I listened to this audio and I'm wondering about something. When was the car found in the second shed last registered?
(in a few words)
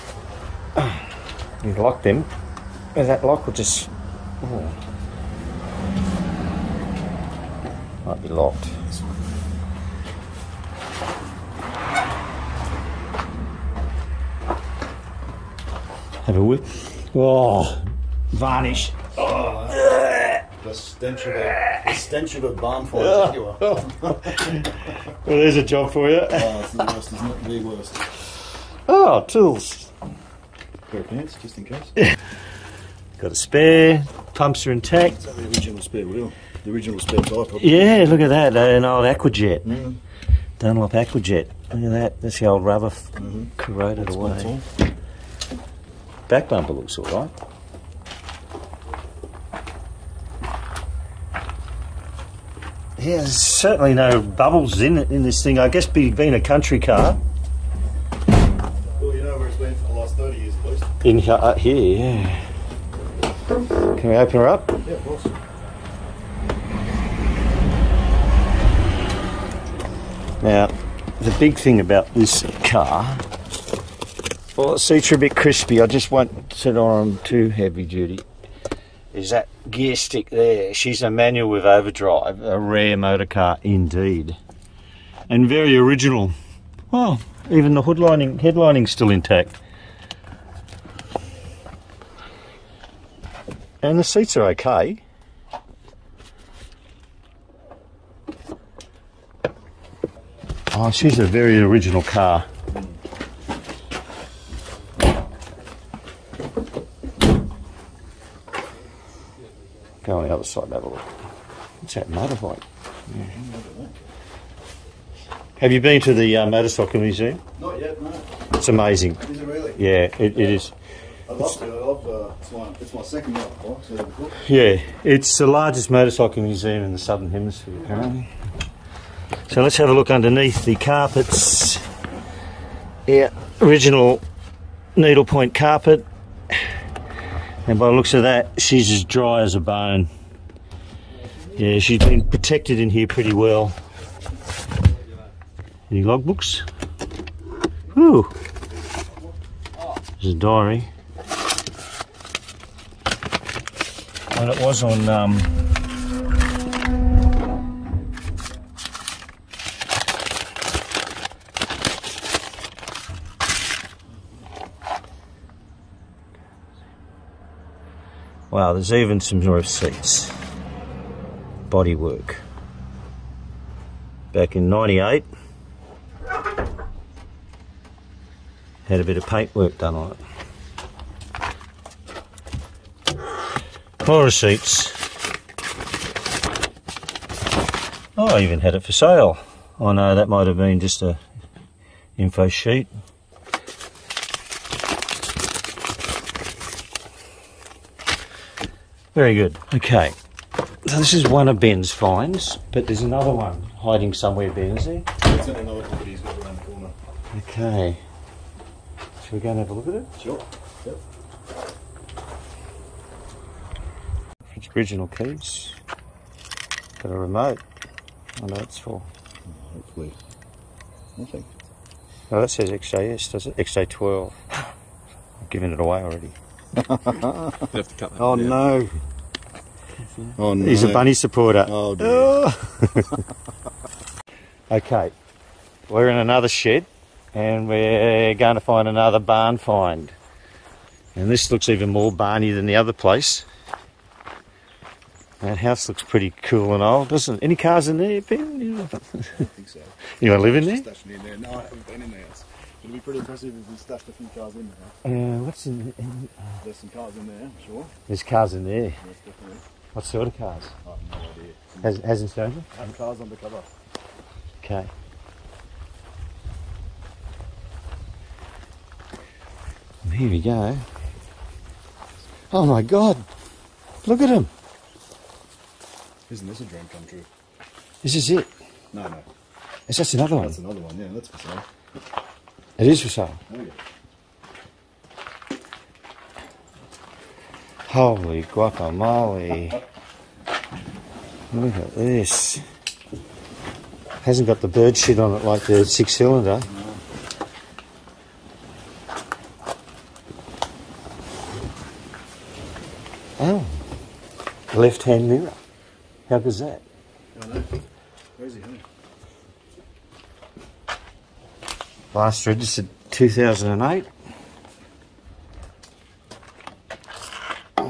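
2008.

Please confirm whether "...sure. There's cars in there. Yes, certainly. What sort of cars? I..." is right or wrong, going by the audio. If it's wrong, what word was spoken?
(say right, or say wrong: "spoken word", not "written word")
wrong: "definitely", not "certainly".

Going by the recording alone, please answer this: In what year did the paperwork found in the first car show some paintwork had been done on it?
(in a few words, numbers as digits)
1998.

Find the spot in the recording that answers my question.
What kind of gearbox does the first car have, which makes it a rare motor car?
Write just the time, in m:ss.
1:21.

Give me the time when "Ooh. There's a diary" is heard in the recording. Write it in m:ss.
2:27.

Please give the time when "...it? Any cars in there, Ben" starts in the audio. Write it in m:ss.
4:07.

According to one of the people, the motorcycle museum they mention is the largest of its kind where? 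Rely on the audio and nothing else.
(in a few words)
Southern Hemisphere.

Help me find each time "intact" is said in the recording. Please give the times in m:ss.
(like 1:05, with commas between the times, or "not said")
0:34, 1:29.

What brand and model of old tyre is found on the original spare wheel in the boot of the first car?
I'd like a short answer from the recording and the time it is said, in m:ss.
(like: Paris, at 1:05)
Dunlop Aquajet, at 0:40.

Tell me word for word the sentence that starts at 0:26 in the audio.
Oh, it's the worst, isn't it?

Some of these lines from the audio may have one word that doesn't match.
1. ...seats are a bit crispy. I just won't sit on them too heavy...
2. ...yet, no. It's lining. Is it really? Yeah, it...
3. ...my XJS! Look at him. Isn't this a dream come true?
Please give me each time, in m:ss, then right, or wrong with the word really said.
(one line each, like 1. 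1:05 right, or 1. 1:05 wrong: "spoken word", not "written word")
1. 1:14 right
2. 1:57 wrong: "amazing", not "lining"
3. 4:32 wrong: "God", not "XJS".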